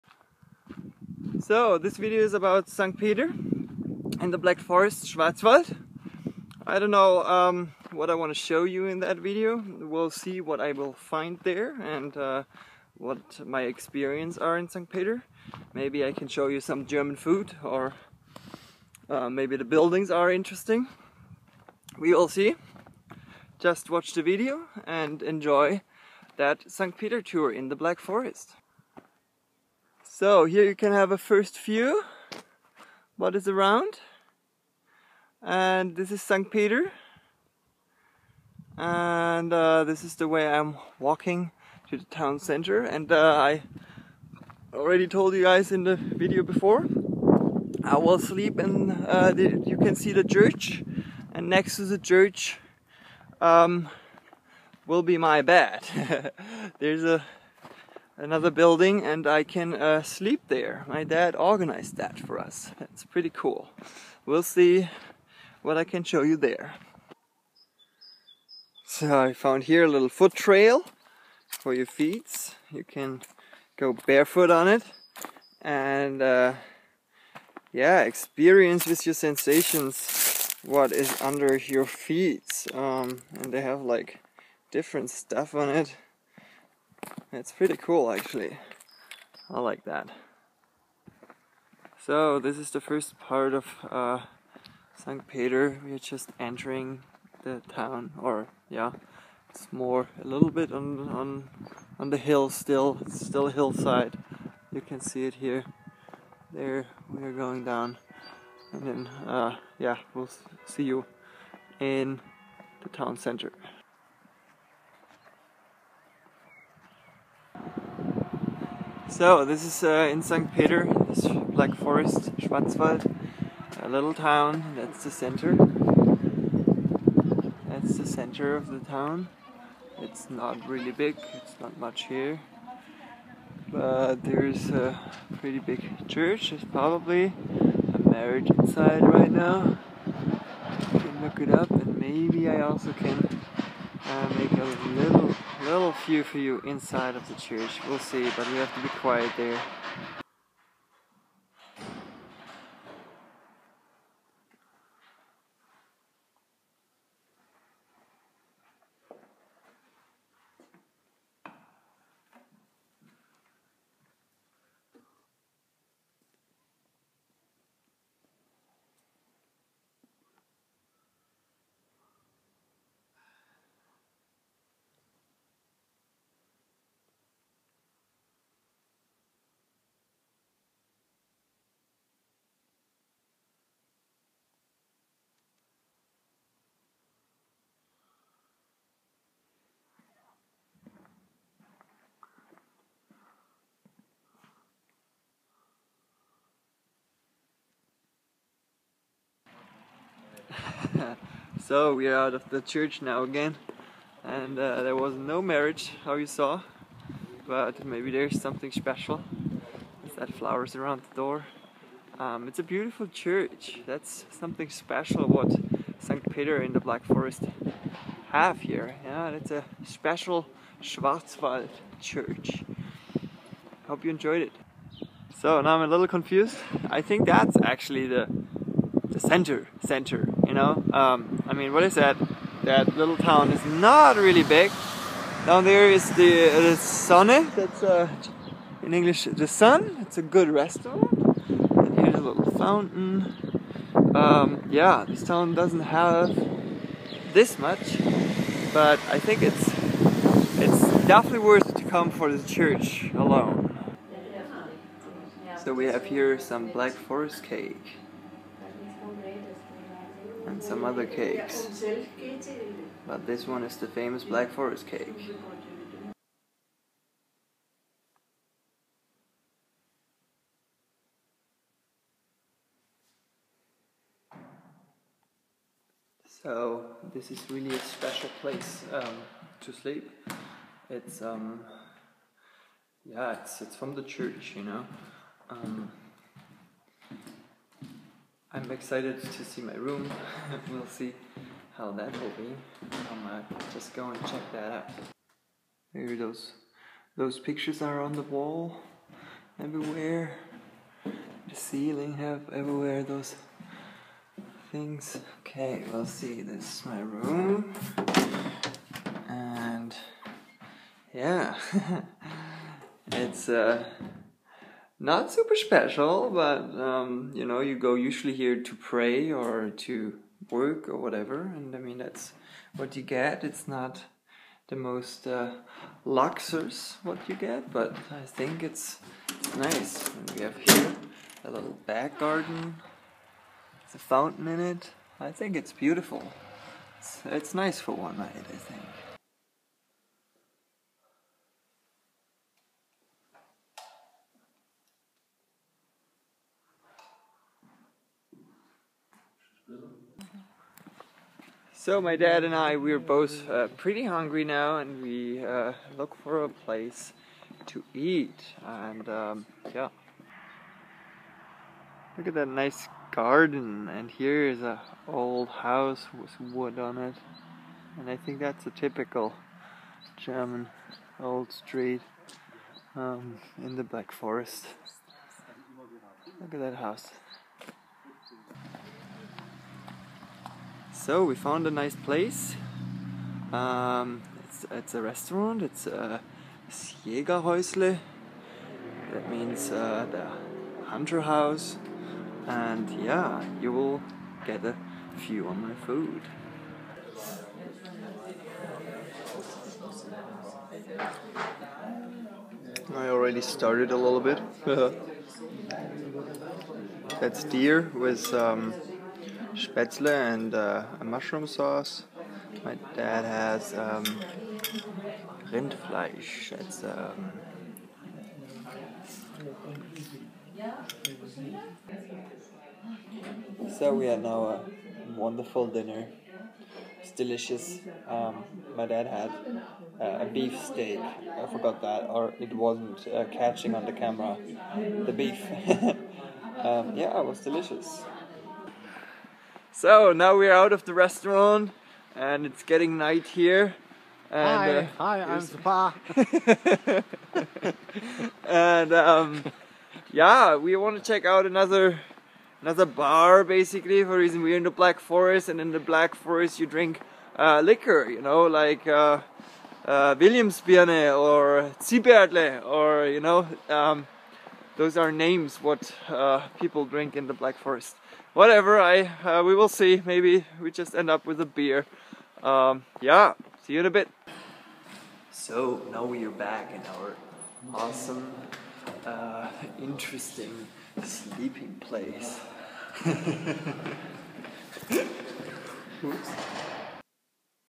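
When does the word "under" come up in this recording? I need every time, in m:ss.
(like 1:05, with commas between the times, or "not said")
1:21.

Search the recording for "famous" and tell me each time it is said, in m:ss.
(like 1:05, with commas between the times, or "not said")
4:23.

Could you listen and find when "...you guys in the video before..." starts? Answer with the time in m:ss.
0:45.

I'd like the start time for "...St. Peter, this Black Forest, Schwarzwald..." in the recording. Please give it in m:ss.
2:00.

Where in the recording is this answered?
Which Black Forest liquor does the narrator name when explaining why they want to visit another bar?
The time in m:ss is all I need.
7:41.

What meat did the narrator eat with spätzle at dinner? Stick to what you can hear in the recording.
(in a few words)
Deer.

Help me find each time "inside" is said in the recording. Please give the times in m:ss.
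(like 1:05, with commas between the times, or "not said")
2:18, 2:26.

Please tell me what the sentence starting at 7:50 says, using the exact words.
Maybe we just end up with a beer.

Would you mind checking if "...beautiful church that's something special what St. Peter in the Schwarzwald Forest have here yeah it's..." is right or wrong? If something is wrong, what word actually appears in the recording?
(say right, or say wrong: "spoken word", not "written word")
wrong: "Black", not "Schwarzwald".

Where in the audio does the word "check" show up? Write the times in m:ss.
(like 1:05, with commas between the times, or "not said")
4:54, 7:31.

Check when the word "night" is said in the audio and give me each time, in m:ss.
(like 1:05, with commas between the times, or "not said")
5:38, 7:22.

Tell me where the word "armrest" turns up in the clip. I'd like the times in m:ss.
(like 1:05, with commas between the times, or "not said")
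not said.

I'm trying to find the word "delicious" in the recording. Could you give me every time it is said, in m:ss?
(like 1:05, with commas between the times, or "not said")
7:07, 7:17.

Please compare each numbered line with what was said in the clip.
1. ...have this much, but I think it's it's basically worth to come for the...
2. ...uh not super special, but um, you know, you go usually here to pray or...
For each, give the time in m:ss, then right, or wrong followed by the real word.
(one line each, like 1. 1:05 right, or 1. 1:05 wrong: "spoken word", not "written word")
1. 4:05 wrong: "definitely", not "basically"
2. 5:13 right.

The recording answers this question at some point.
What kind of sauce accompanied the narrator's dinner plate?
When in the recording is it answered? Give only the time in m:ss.
6:51.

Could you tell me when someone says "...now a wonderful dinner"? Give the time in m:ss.
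7:04.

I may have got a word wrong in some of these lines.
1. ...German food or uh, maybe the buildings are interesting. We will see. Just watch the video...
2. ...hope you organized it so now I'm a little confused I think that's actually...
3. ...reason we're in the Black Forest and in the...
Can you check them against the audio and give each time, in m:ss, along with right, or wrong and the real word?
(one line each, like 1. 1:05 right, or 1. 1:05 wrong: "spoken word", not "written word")
1. 0:16 right
2. 3:43 wrong: "enjoyed", not "organized"
3. 7:34 right.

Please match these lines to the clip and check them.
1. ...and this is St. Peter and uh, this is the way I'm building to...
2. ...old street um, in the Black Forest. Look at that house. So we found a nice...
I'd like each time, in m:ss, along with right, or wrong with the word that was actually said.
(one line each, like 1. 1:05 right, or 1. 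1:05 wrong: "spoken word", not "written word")
1. 0:35 wrong: "walking", not "building"
2. 6:11 right.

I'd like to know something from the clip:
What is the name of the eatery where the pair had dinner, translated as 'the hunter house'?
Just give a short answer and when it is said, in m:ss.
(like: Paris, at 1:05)
Jägerhäusle, at 6:26.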